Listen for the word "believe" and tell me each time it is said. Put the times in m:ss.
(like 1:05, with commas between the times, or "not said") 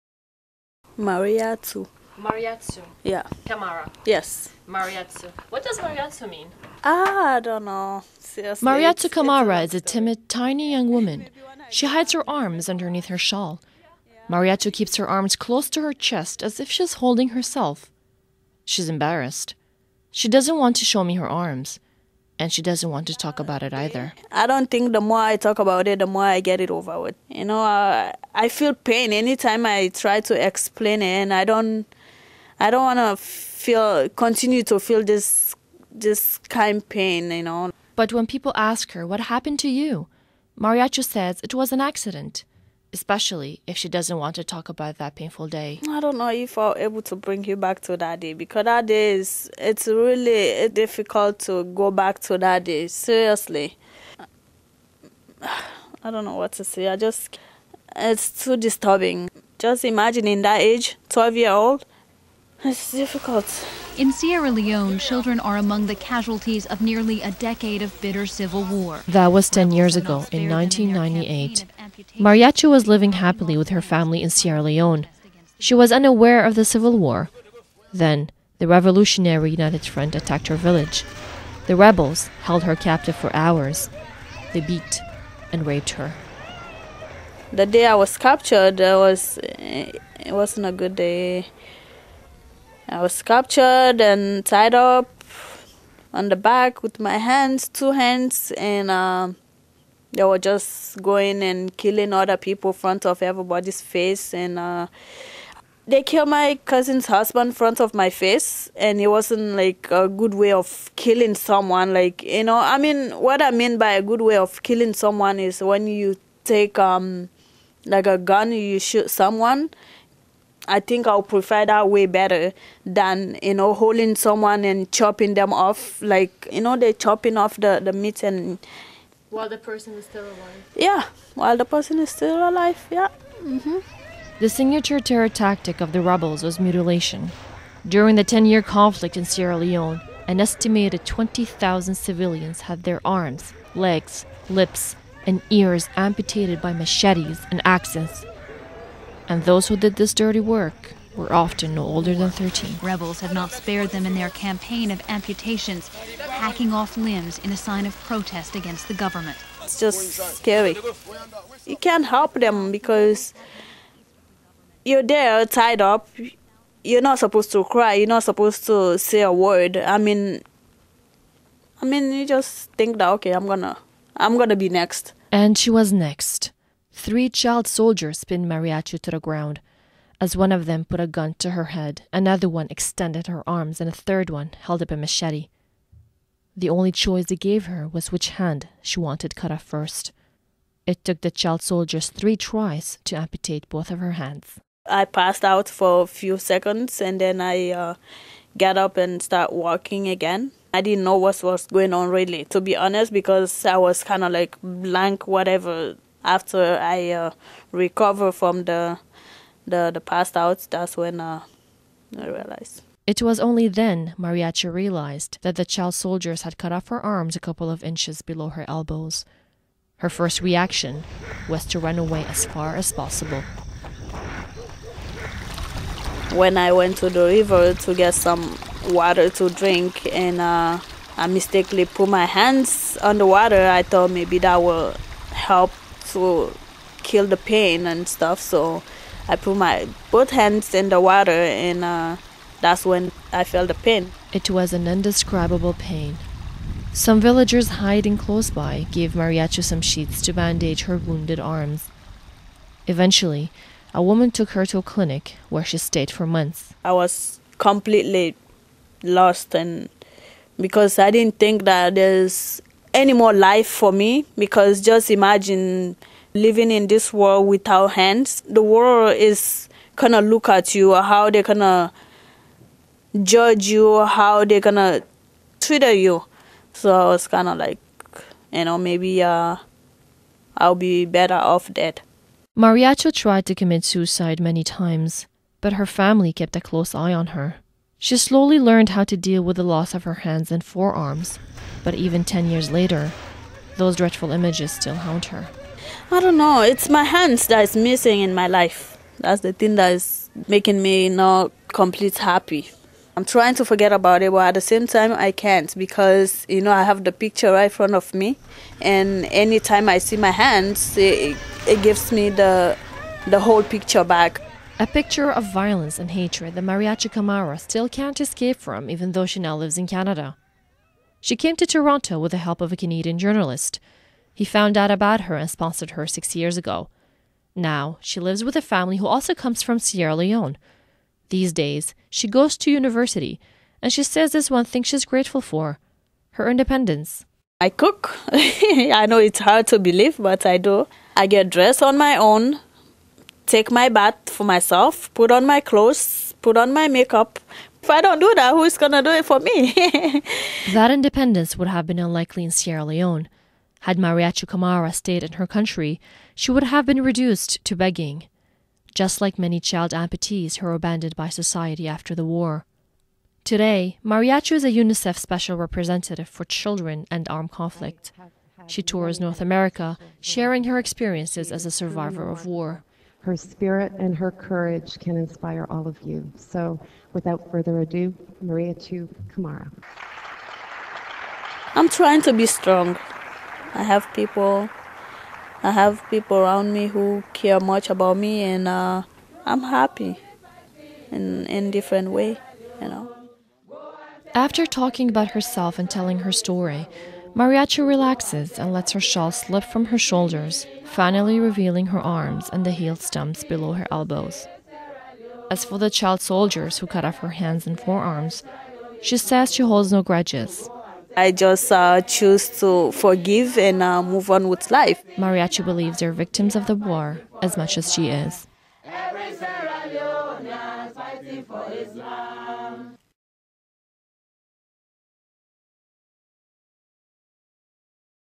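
5:39, 6:55.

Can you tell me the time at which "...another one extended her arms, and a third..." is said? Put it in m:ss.
3:02.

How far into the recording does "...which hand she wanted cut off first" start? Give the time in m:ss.
3:08.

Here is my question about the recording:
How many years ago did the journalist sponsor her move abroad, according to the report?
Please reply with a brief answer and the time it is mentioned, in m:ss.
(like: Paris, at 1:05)
6, at 5:26.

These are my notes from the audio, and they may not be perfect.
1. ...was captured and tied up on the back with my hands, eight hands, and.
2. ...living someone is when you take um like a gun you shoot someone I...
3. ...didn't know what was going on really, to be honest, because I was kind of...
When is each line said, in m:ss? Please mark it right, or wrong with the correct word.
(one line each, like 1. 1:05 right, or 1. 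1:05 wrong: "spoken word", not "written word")
1. 1:33 wrong: "two", not "eight"
2. 1:54 wrong: "killing", not "living"
3. 3:20 right.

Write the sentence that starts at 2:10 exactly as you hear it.
Yeah, while the person is still alive, yeah.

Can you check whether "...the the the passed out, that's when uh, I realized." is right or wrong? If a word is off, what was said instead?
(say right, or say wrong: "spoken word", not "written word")
right.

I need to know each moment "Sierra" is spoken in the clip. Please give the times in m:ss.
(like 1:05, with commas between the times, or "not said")
1:04, 1:14, 2:19, 5:29, 5:52.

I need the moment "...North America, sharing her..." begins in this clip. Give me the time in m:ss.
6:09.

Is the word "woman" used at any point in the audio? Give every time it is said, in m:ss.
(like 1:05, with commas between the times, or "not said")
0:10, 4:14.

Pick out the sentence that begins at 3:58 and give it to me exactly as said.
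So I put my both hands in the water and uh, that's when I felt the pain.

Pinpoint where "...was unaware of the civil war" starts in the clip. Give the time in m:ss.
1:15.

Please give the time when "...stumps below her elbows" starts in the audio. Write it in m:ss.
6:42.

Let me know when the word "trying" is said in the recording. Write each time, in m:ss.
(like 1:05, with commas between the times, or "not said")
5:03, 6:21.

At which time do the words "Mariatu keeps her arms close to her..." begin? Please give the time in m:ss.
0:14.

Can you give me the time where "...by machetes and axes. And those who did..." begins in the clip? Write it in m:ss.
2:26.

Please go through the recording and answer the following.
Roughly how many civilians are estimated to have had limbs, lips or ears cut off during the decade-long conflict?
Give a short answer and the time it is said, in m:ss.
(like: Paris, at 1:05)
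20,000, at 2:21.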